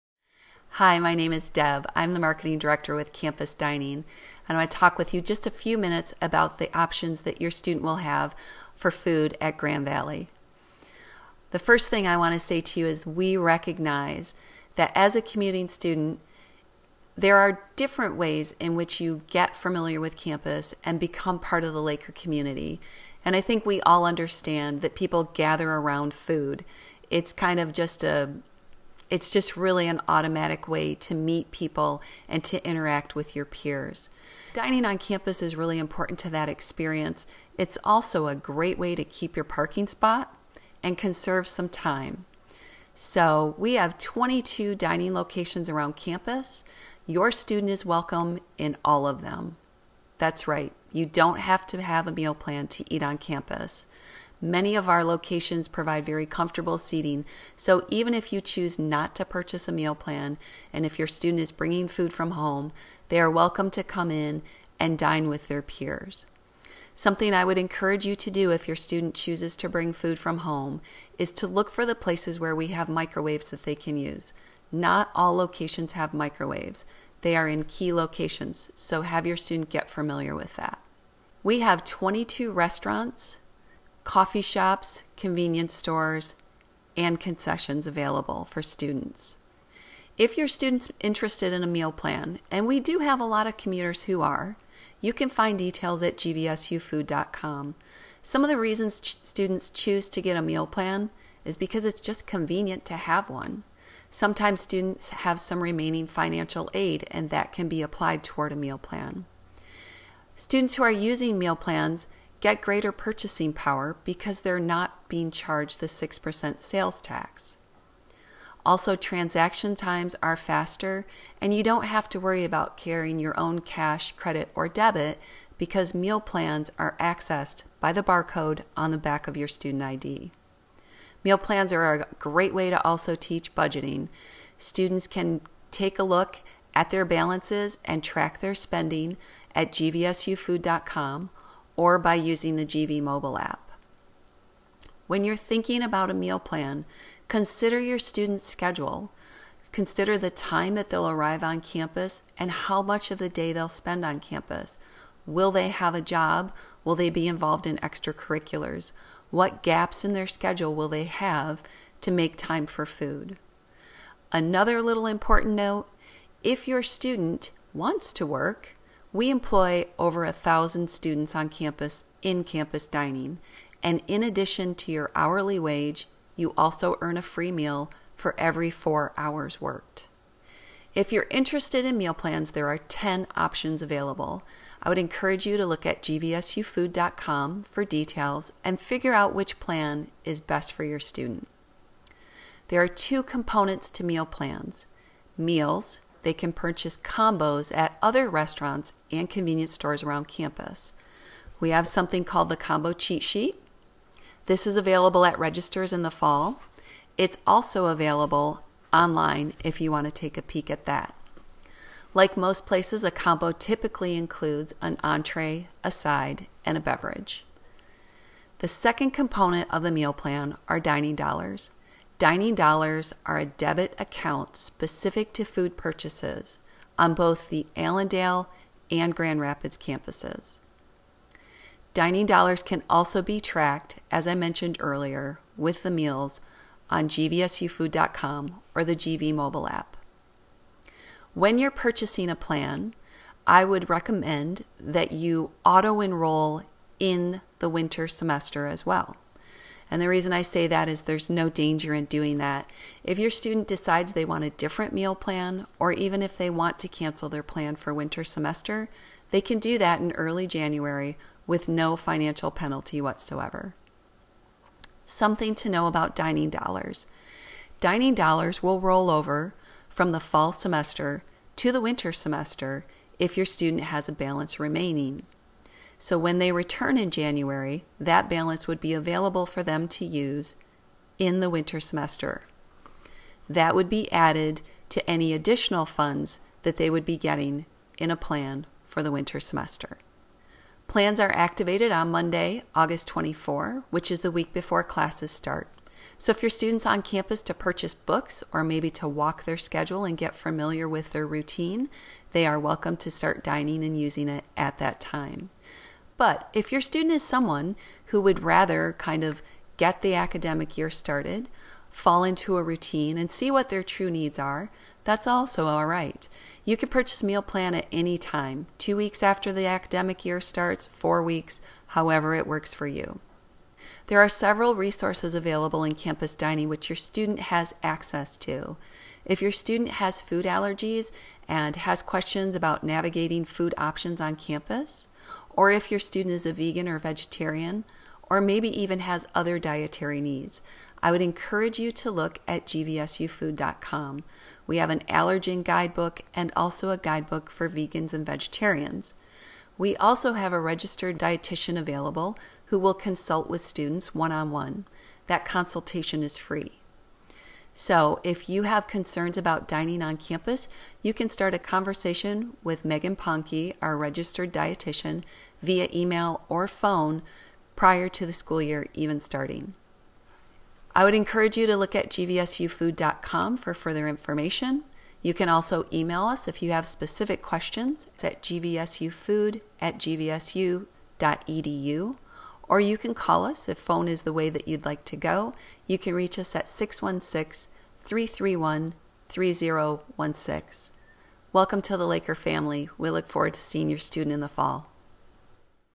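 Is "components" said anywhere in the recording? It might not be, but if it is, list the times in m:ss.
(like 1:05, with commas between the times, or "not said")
3:13, 3:39.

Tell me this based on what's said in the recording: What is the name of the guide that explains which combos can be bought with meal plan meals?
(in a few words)
Combo Cheat Sheet.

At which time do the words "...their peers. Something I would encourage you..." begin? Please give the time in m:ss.
1:05.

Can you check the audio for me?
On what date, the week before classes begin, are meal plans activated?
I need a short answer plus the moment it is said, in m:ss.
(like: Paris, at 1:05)
Monday, August 24, at 4:52.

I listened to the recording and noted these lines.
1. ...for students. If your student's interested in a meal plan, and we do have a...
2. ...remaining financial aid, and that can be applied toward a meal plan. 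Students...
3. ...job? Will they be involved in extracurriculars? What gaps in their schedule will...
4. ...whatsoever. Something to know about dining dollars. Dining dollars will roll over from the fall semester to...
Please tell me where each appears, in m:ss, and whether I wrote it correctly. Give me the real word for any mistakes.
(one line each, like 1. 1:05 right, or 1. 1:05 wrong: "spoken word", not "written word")
1. 1:28 right
2. 1:45 right
3. 2:36 right
4. 4:23 right.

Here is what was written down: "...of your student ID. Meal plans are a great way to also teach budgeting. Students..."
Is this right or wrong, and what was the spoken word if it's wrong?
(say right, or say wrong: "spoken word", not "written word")
right.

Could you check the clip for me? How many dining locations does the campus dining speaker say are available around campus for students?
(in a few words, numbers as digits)
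22.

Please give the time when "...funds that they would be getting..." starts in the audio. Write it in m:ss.
4:45.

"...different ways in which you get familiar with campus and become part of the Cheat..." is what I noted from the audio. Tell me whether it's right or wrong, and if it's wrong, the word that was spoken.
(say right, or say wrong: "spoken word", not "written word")
wrong: "Laker", not "Cheat".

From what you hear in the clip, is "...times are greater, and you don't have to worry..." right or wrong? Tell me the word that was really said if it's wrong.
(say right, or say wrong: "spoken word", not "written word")
wrong: "faster", not "greater".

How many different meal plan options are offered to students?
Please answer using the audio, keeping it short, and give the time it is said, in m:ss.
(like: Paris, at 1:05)
10, at 3:02.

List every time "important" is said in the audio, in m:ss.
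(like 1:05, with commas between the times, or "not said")
0:35, 2:45.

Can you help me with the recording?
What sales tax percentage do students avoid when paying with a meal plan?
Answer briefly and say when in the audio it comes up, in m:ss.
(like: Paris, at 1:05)
6%, at 1:55.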